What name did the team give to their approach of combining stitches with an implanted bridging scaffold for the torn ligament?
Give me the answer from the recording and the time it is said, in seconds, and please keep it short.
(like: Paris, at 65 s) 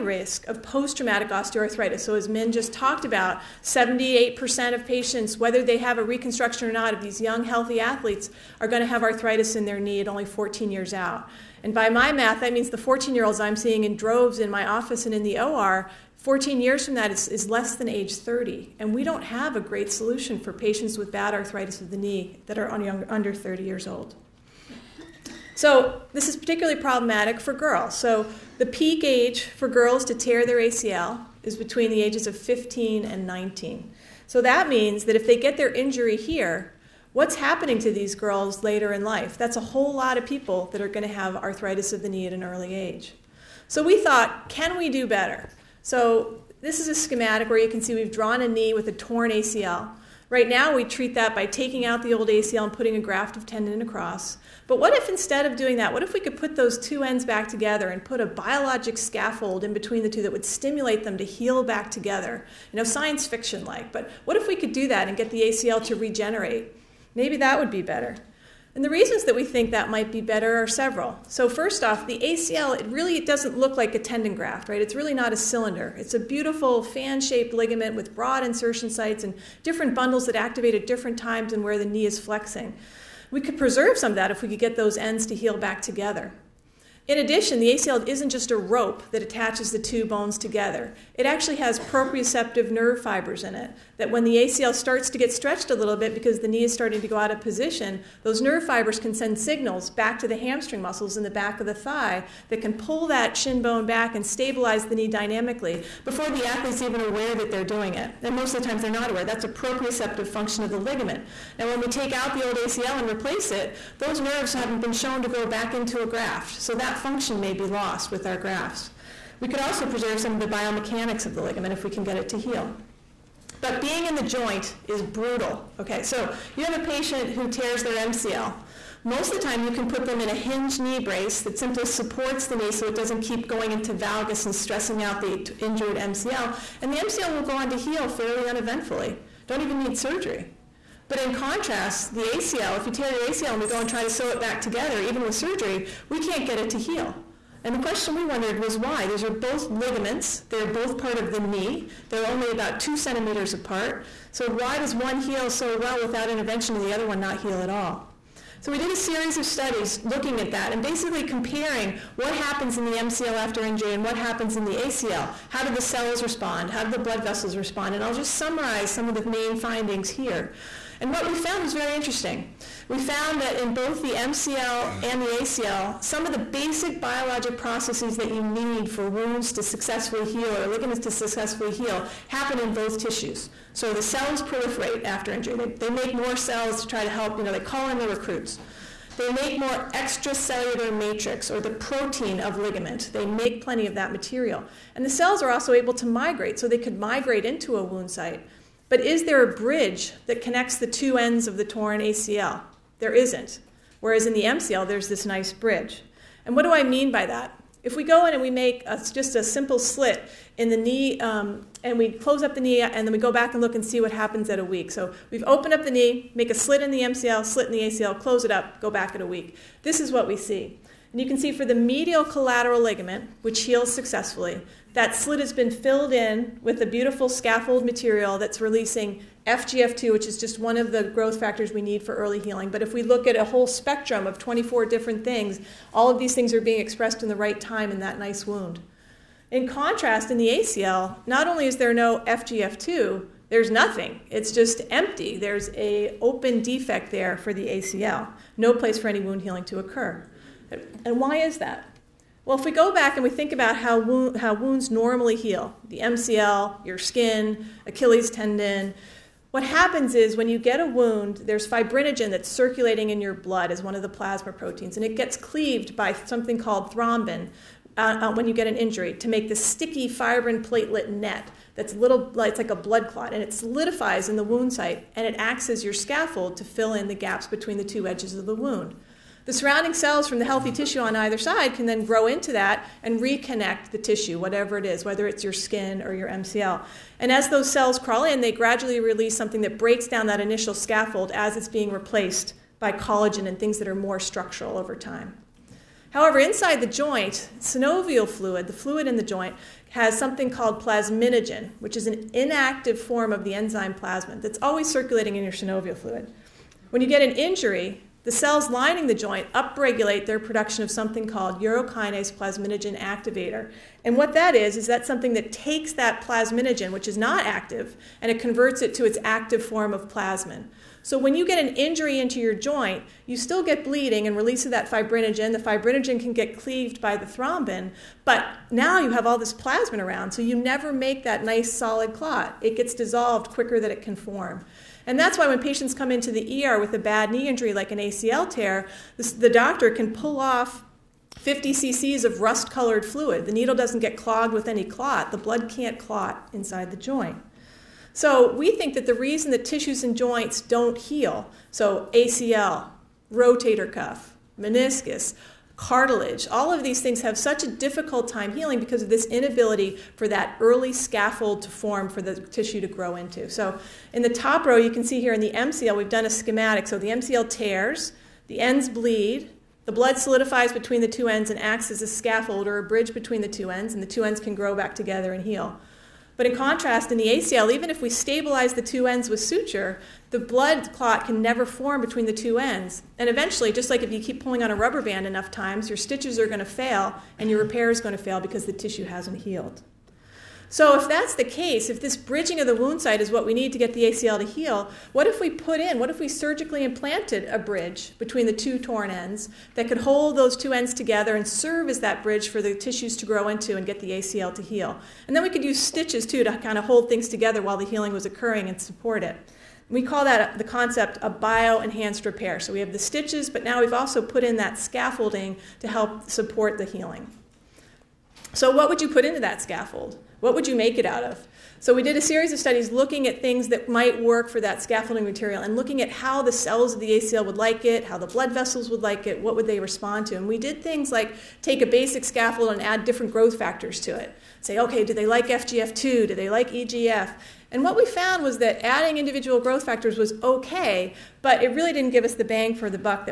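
bio enhanced repair, at 411 s.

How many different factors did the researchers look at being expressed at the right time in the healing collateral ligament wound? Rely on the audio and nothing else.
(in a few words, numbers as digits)
24.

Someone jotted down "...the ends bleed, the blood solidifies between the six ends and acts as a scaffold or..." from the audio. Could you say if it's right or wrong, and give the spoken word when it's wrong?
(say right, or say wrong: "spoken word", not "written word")
wrong: "two", not "six".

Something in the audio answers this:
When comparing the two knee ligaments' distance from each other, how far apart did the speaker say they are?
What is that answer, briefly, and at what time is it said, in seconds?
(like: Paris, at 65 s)
2 centimeters, at 152 s.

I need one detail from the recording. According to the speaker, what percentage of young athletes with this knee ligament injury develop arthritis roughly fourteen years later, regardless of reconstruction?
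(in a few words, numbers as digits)
78%.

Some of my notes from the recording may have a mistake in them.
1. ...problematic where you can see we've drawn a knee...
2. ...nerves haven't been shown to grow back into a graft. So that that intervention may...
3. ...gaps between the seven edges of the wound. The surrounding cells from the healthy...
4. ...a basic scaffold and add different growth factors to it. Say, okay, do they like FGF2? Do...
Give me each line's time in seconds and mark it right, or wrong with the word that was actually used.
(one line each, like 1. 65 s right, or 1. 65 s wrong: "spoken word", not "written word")
1. 46 s wrong: "schematic", not "problematic"
2. 114 s wrong: "function", not "intervention"
3. 277 s wrong: "two", not "seven"
4. 431 s right.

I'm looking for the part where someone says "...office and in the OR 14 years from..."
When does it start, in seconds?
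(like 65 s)
14 s.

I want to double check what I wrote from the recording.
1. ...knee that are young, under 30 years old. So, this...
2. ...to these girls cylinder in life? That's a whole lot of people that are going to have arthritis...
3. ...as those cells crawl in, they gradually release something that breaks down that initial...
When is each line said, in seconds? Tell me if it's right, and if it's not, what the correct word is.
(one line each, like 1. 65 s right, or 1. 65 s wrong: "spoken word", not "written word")
1. 21 s right
2. 37 s wrong: "later", not "cylinder"
3. 287 s right.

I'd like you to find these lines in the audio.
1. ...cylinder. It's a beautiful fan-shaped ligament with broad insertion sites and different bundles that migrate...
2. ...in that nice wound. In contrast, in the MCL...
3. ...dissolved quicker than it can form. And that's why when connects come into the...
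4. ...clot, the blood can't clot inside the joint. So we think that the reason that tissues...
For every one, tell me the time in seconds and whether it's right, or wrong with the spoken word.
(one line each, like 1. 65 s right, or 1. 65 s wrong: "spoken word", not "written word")
1. 75 s wrong: "activate", not "migrate"
2. 237 s wrong: "ACL", not "MCL"
3. 332 s wrong: "patients", not "connects"
4. 344 s right.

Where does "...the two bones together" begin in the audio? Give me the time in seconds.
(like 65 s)
89 s.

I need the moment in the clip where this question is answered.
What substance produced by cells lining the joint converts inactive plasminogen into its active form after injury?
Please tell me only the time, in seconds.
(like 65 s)
311 s.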